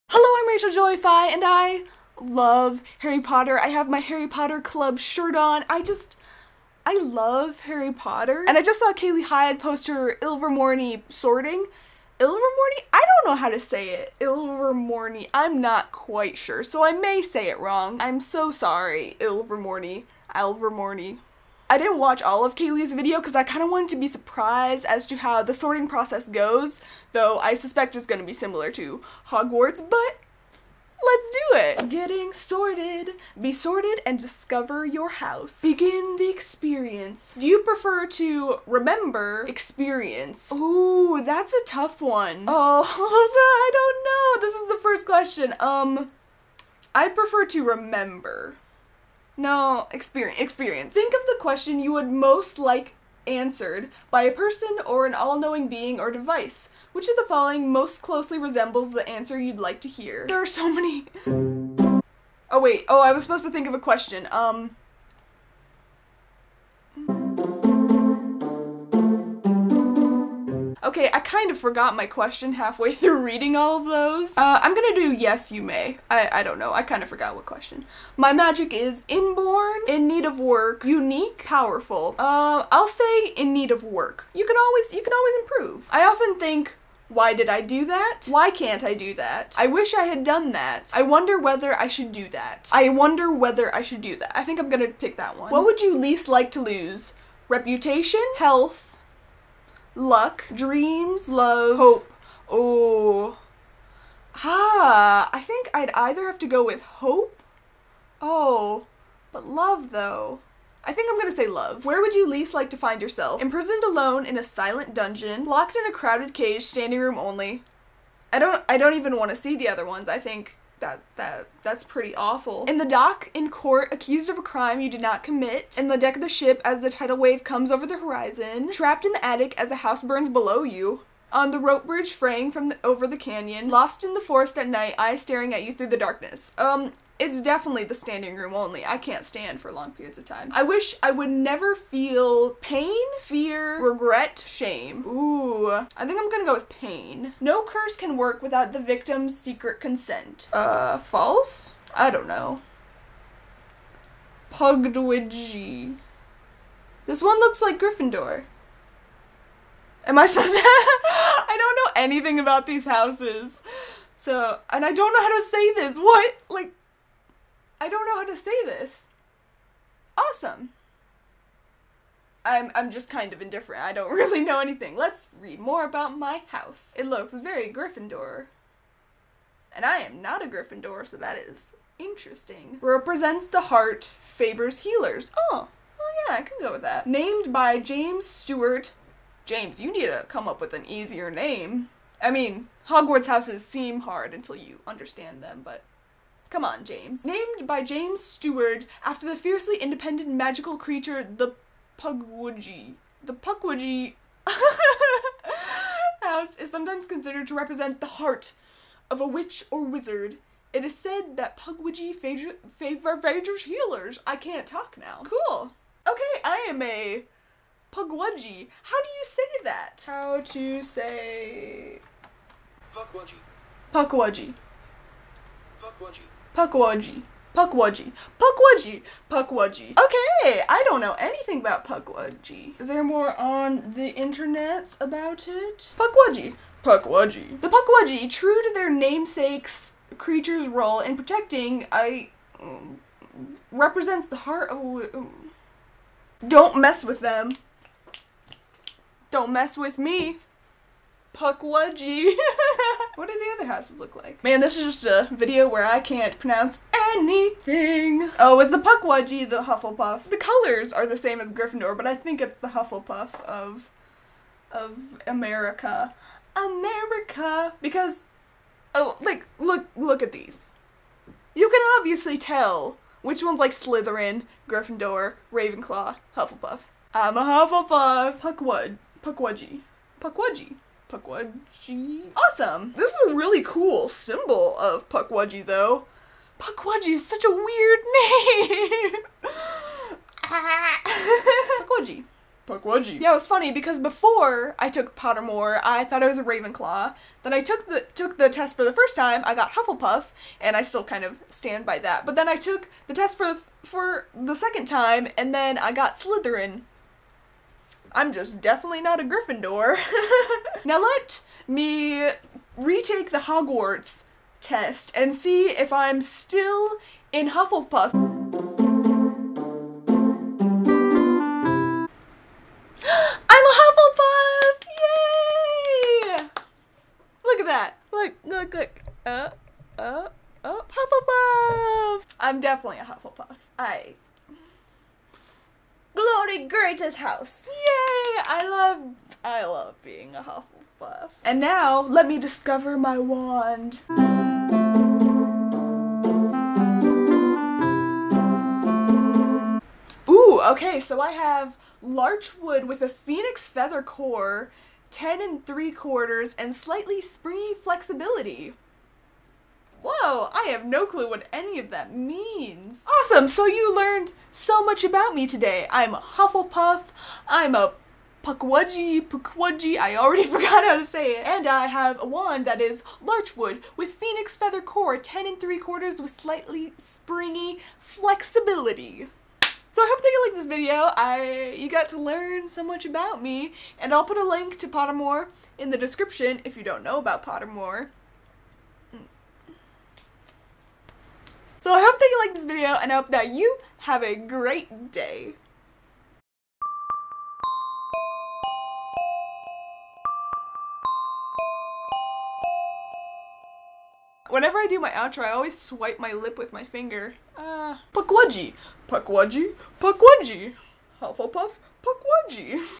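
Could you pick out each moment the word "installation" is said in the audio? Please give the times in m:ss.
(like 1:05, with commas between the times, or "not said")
not said.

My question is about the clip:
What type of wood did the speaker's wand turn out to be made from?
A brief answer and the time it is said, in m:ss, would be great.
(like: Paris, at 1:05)
Larch, at 5:52.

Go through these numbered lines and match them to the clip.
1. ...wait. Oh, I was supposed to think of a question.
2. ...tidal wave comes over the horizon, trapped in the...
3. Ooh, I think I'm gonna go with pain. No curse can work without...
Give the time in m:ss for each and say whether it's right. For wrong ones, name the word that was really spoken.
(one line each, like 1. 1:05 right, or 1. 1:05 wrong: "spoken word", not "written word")
1. 1:02 right
2. 2:06 right
3. 2:25 right.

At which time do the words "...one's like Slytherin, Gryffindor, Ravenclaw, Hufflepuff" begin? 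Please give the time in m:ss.
4:33.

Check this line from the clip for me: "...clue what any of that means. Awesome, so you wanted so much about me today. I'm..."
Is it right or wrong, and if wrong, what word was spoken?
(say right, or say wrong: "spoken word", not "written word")
wrong: "learned", not "wanted".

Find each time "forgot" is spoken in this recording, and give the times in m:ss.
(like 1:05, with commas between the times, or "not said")
1:11, 1:17, 6:10.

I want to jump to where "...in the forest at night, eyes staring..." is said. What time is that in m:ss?
2:14.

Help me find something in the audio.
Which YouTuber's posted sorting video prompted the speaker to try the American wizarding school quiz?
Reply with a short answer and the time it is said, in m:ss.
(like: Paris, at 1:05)
Kayley Hyde, at 0:08.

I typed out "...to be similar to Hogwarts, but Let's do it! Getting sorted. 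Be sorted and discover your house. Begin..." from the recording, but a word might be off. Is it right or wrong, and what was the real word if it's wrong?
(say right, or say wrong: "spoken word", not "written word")
right.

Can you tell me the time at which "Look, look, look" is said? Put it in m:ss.
5:28.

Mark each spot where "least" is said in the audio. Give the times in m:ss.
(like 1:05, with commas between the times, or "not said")
1:35, 1:52.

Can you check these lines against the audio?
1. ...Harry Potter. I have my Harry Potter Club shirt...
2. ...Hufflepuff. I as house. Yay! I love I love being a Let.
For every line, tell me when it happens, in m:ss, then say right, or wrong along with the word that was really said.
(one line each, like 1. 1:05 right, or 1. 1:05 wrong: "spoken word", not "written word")
1. 0:02 right
2. 5:33 wrong: "Hufflepuff", not "Let".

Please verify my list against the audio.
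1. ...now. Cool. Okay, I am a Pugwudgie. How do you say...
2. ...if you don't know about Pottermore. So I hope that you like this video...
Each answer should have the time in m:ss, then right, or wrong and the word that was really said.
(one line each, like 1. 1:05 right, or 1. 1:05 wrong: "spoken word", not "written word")
1. 3:34 right
2. 6:26 right.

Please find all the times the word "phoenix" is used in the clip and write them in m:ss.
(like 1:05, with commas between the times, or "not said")
5:53, 6:14.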